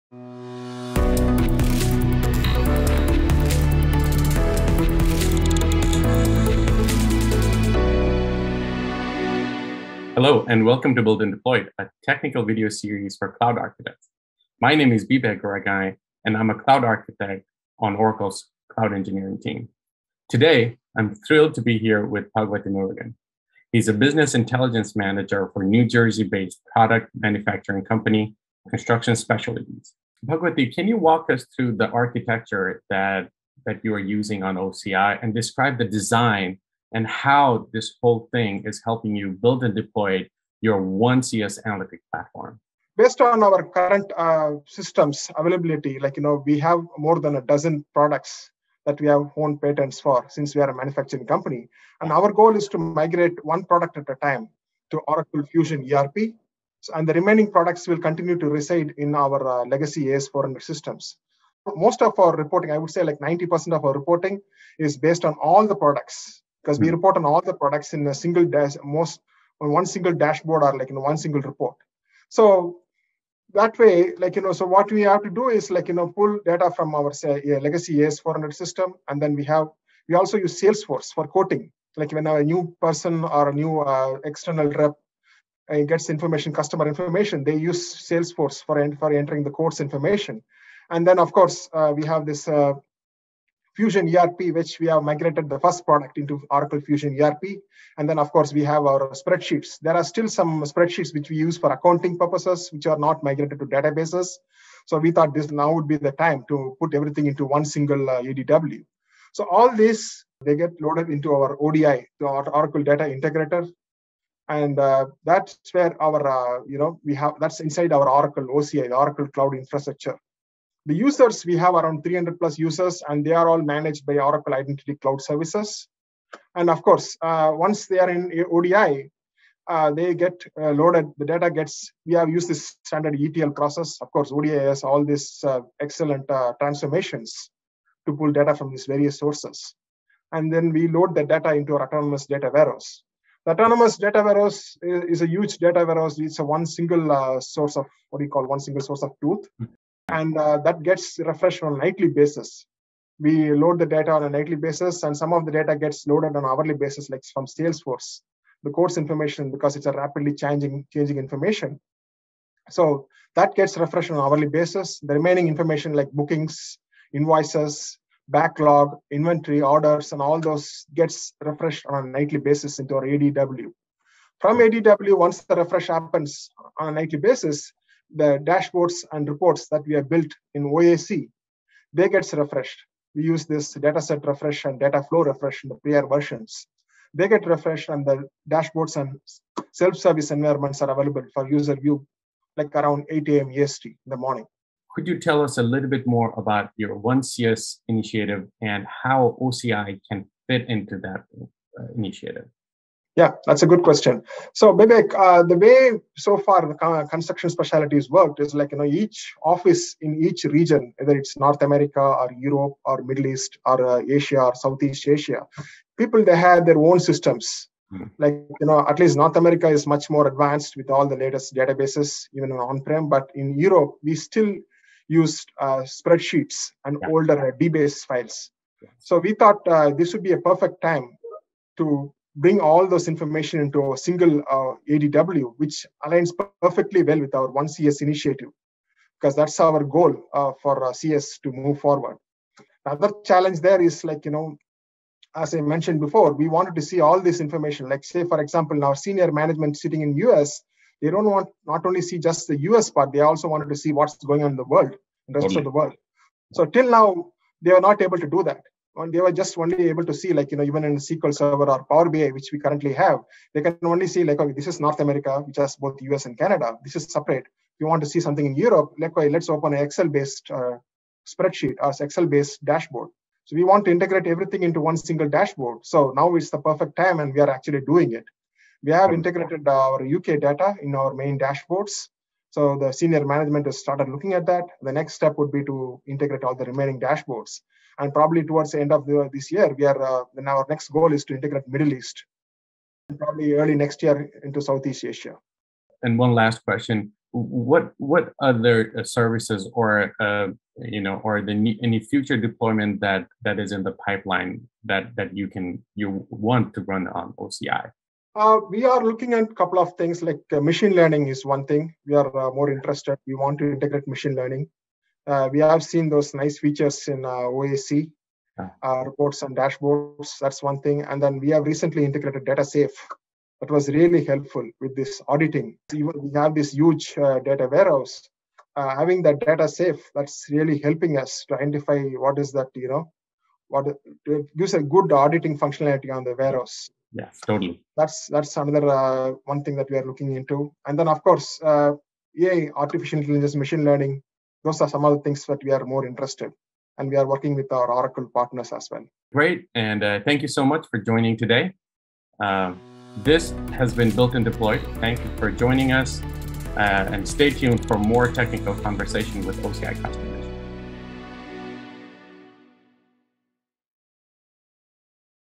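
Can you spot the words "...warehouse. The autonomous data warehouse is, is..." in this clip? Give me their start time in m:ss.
2:22.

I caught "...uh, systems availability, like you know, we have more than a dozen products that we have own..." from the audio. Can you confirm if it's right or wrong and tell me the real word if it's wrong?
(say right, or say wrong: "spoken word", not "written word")
right.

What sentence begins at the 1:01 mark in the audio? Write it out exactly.
Most of our reporting, I would say like 90% of our reporting is based on all the products because we hmm.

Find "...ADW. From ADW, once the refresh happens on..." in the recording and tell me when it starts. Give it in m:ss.
2:53.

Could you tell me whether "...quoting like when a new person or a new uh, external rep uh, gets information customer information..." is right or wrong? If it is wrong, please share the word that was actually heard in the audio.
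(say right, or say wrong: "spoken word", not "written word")
right.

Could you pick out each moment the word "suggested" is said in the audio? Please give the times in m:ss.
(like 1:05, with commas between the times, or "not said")
not said.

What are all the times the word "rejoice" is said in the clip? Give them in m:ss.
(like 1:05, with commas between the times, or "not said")
not said.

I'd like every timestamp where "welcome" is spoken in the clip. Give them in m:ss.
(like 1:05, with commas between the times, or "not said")
0:10.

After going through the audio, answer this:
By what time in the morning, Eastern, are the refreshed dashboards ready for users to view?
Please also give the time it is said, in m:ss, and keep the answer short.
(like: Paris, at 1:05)
8 a.m., at 3:13.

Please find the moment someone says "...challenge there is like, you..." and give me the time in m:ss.
4:03.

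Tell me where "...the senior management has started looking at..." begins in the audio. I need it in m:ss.
4:42.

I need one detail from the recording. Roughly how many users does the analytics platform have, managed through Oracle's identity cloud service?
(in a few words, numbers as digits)
300 plus.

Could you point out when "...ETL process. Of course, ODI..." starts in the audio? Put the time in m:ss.
2:13.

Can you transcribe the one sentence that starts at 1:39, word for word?
There are still some spreadsheets which we use for accounting purposes, which are not migrated to databases.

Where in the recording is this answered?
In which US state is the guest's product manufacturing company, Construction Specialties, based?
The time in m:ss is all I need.
0:25.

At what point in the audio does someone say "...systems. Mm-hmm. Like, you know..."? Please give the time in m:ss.
3:37.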